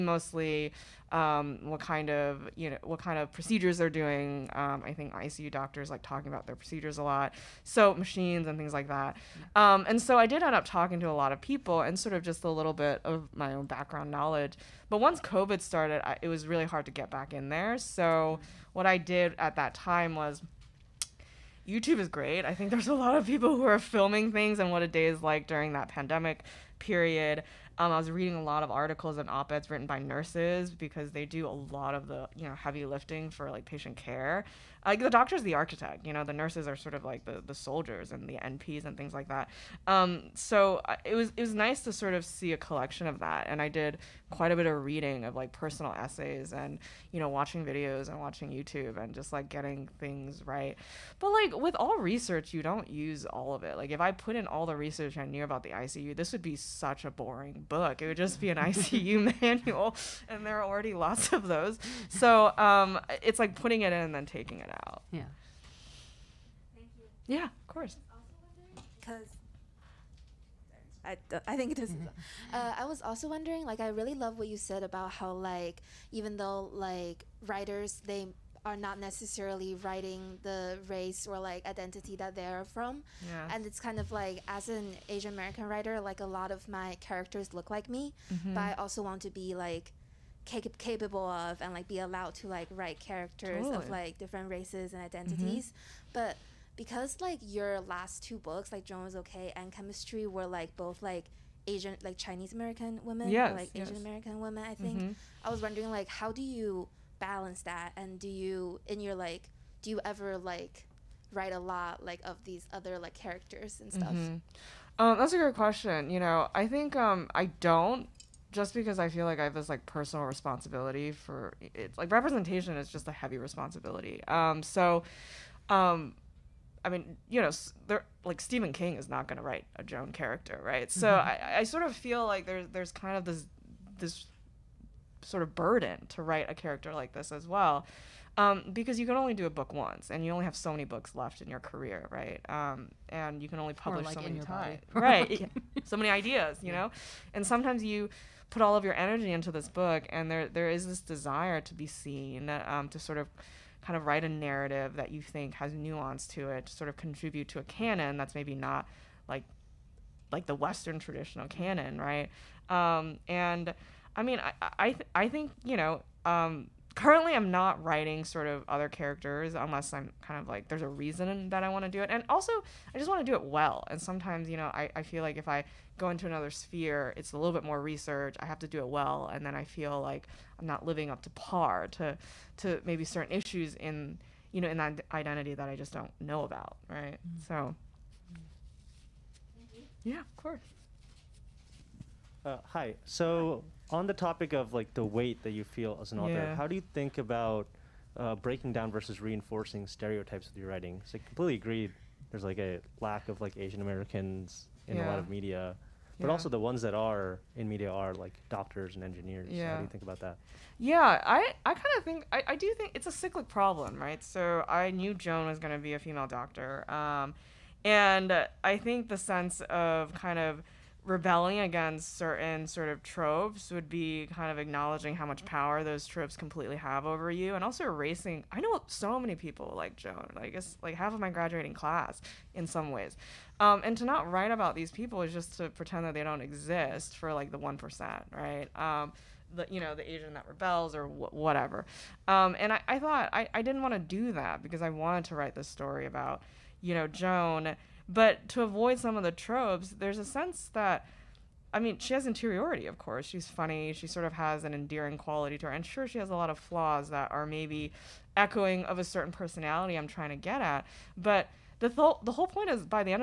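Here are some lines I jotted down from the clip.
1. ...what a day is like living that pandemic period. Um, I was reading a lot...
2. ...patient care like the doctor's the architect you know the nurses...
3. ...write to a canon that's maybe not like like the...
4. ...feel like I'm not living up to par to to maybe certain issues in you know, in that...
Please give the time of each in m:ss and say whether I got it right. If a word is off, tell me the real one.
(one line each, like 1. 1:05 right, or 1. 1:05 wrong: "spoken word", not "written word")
1. 0:24 wrong: "during", not "living"
2. 0:33 right
3. 2:36 wrong: "contribute", not "write"
4. 2:59 right.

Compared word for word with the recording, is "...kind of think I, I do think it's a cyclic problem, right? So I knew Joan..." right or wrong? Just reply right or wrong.
right.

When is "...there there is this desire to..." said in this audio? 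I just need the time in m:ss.
2:30.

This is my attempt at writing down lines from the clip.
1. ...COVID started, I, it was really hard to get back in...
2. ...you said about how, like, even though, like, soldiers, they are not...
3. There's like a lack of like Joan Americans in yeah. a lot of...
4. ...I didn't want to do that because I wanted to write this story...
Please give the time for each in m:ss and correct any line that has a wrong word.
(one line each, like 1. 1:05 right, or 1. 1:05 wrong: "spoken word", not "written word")
1. 0:15 right
2. 1:14 wrong: "writers", not "soldiers"
3. 3:22 wrong: "Asian", not "Joan"
4. 4:03 right.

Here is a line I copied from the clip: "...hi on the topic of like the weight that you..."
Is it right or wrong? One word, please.
right.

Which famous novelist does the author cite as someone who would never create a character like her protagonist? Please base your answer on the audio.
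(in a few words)
Stephen King.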